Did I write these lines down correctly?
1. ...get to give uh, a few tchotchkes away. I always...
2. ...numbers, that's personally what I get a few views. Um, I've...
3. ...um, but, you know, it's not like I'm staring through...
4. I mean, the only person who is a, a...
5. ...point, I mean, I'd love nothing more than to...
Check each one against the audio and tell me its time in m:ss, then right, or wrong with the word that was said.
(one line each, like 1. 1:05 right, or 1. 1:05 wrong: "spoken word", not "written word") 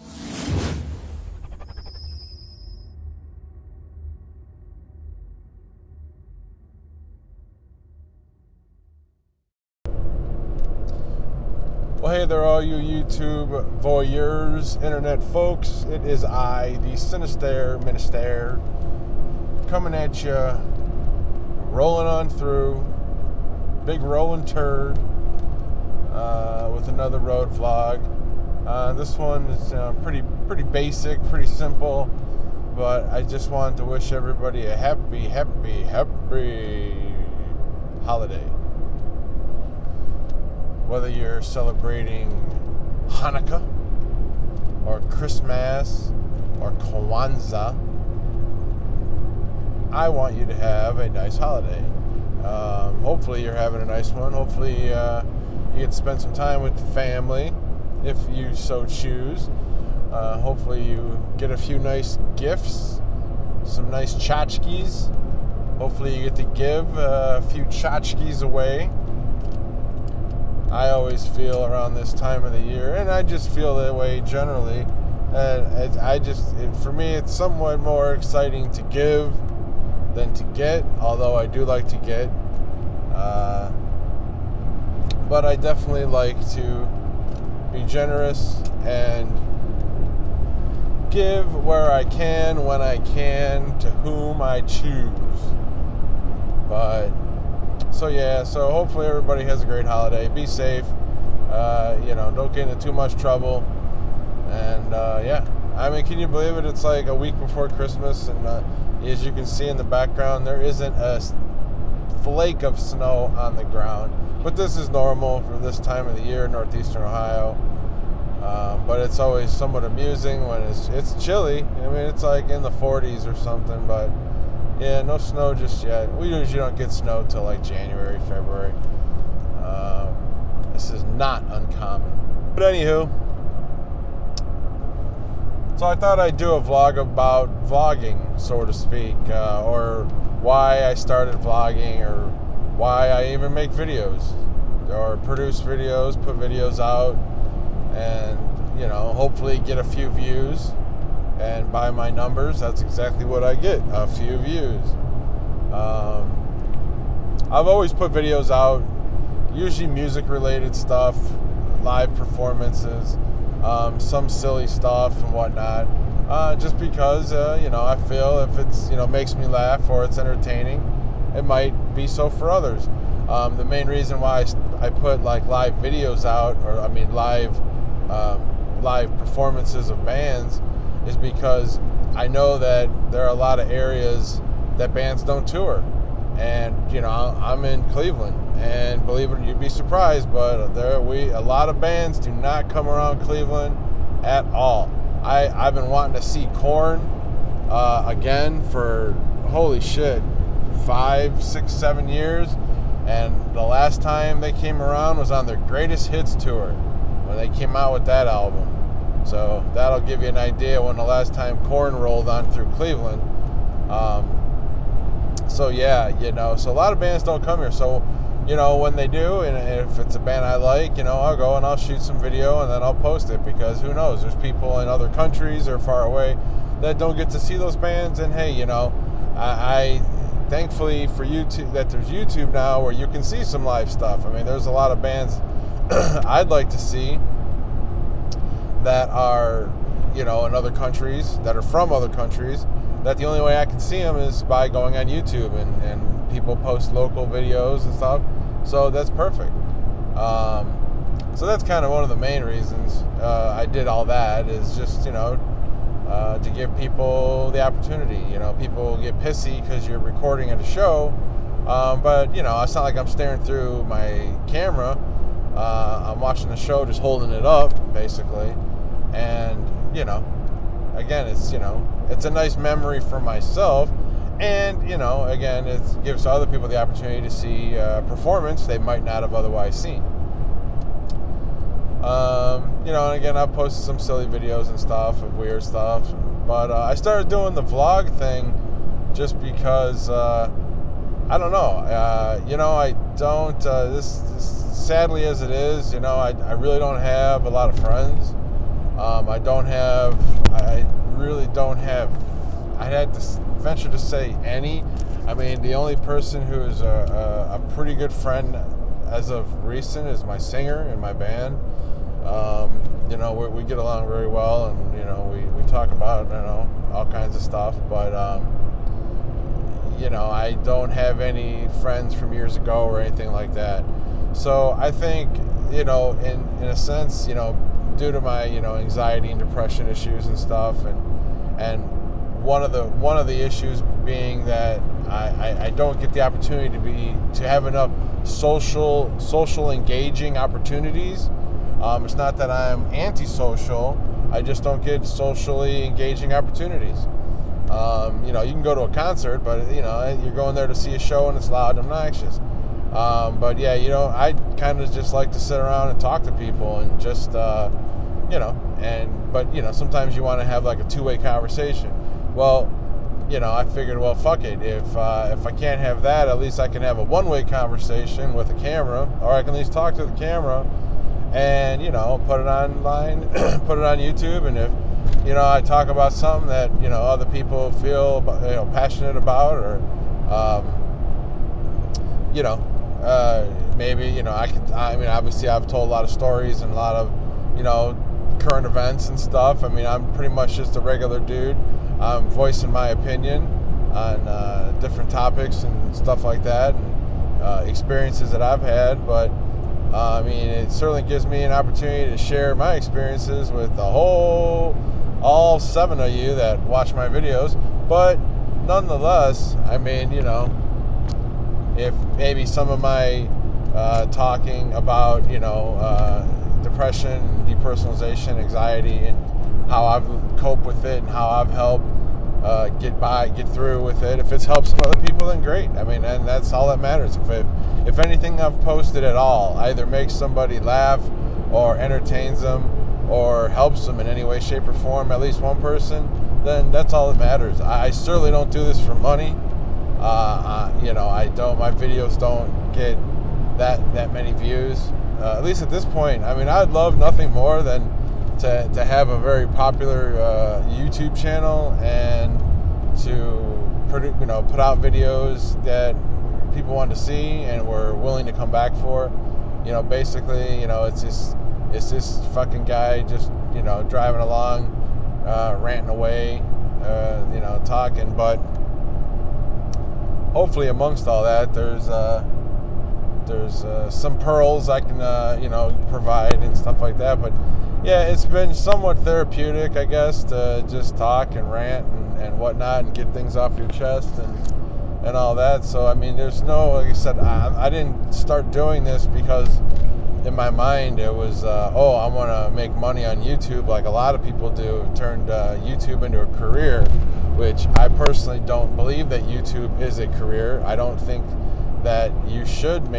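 1. 1:06 right
2. 2:32 wrong: "exactly", not "personally"
3. 4:21 right
4. 5:05 right
5. 7:25 right.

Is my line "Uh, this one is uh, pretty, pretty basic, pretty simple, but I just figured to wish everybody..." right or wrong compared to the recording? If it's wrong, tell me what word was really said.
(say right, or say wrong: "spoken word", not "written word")
wrong: "wanted", not "figured".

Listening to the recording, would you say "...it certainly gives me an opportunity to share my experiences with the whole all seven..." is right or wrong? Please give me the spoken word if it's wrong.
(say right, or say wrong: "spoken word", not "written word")
right.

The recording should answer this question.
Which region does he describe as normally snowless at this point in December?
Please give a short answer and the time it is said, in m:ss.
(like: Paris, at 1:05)
Northeastern Ohio, at 1:56.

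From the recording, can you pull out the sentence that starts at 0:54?
Hopefully, uh, you get to spend some time with family if you so choose.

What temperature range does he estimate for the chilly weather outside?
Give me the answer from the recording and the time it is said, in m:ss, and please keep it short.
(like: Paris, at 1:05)
The 40s, at 2:02.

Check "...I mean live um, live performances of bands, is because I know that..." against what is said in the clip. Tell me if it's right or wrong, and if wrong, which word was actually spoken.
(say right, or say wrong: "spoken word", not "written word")
right.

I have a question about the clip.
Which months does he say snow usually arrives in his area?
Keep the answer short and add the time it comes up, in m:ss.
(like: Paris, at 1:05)
January, February, at 2:07.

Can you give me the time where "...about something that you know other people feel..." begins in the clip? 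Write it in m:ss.
6:15.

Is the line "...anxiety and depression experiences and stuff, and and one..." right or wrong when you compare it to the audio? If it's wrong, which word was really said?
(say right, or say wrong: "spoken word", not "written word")
wrong: "issues", not "experiences".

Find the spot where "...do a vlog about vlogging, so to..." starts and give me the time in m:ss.
2:16.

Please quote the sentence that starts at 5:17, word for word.
But um, you know, I don't have any friends from years ago or anything like that.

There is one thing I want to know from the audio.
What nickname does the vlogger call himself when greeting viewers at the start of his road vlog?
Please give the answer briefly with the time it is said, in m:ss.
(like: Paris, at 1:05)
Sinister Minister, at 0:16.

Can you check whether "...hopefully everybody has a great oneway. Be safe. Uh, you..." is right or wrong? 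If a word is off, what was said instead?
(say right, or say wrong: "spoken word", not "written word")
wrong: "holiday", not "oneway".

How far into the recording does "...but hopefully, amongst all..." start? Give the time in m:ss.
7:48.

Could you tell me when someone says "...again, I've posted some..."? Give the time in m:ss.
4:43.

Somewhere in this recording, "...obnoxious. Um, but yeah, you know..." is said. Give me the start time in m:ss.
5:51.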